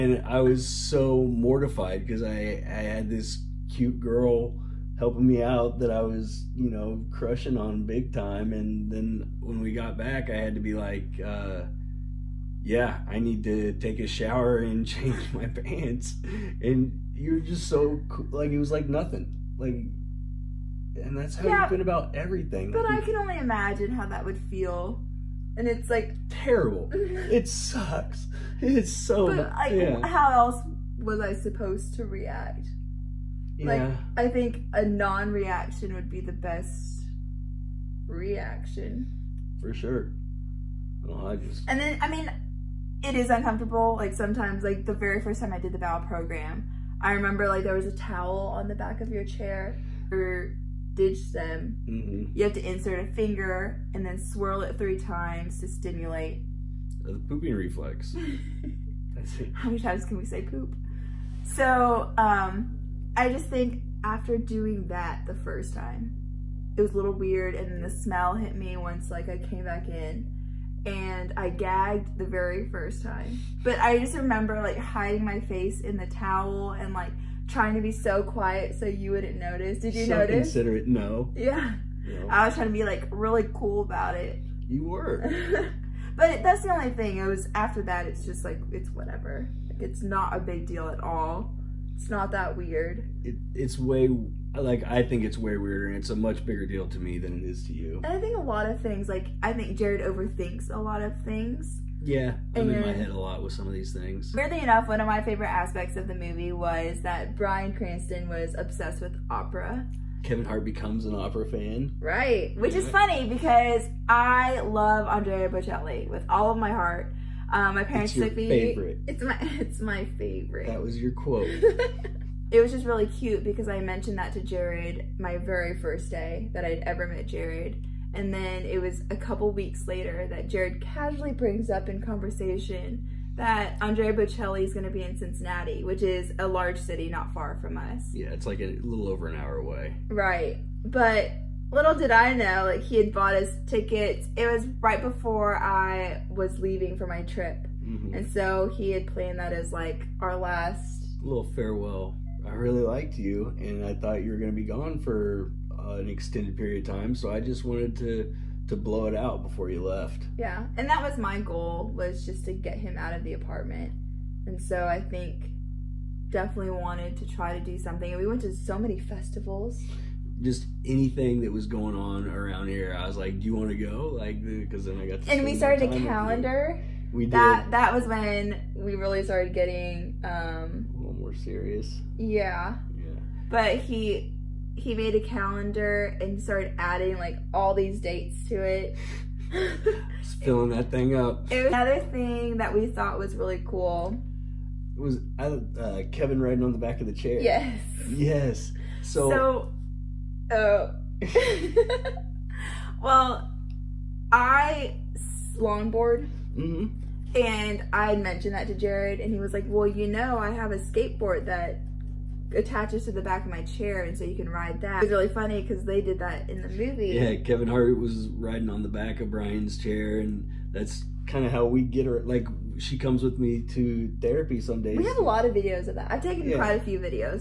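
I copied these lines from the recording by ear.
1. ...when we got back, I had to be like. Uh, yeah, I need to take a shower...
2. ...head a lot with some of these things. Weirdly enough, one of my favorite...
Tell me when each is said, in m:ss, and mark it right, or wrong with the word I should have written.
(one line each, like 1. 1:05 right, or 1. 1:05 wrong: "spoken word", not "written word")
1. 0:09 right
2. 1:42 right.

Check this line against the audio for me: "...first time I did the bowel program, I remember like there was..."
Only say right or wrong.
right.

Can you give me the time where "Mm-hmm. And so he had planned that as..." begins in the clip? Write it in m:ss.
2:27.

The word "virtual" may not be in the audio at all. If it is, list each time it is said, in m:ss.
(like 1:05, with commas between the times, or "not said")
not said.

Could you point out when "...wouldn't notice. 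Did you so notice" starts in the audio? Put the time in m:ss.
1:19.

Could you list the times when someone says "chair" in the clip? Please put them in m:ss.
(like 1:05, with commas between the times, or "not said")
0:49, 3:17, 3:33, 3:39.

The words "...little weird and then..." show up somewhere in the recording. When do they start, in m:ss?
1:06.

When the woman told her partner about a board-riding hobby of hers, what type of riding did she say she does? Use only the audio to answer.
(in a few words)
Longboard.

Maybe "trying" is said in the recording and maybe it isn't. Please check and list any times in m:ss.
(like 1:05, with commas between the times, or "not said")
1:17, 1:22.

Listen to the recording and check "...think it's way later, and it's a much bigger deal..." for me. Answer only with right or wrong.
wrong.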